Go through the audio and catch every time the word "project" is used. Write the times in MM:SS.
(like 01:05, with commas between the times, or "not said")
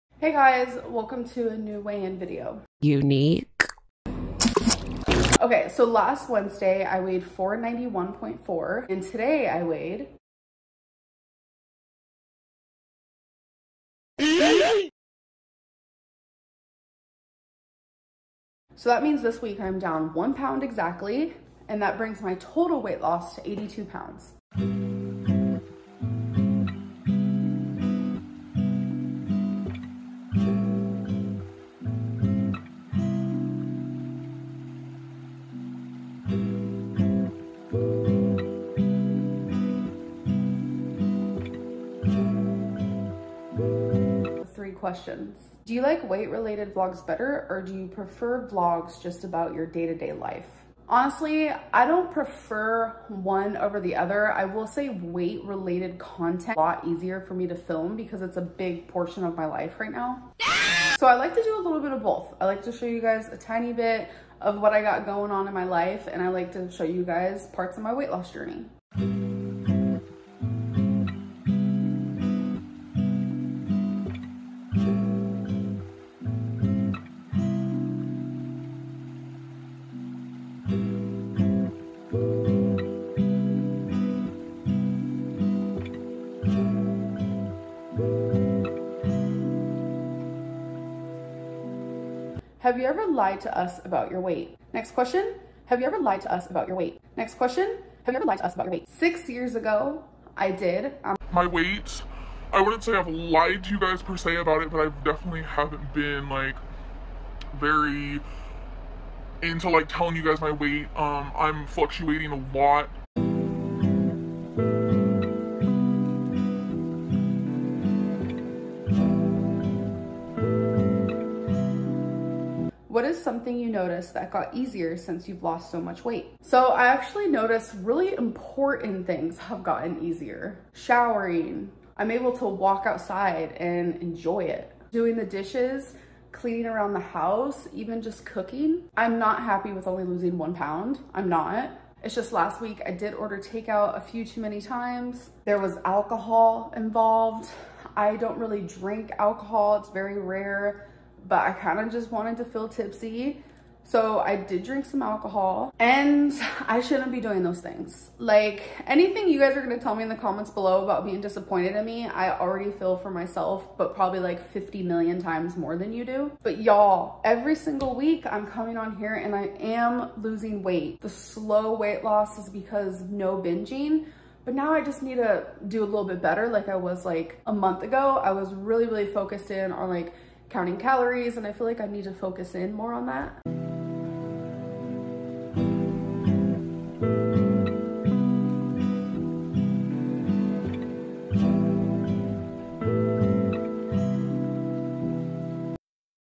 not said.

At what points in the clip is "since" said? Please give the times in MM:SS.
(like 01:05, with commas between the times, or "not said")
02:04.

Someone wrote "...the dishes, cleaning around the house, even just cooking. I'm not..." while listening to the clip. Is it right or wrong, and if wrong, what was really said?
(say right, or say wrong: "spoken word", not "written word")
right.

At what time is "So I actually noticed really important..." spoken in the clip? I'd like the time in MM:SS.
02:06.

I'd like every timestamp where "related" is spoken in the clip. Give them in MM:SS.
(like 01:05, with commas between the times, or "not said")
00:46, 00:55.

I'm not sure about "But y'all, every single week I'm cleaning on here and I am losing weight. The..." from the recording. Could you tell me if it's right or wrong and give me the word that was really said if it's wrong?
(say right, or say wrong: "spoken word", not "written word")
wrong: "coming", not "cleaning".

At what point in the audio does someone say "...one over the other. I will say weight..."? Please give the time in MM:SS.
00:53.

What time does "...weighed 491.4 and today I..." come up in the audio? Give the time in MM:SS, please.
00:06.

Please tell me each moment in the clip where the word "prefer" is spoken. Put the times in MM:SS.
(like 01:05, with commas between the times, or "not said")
00:47, 00:52.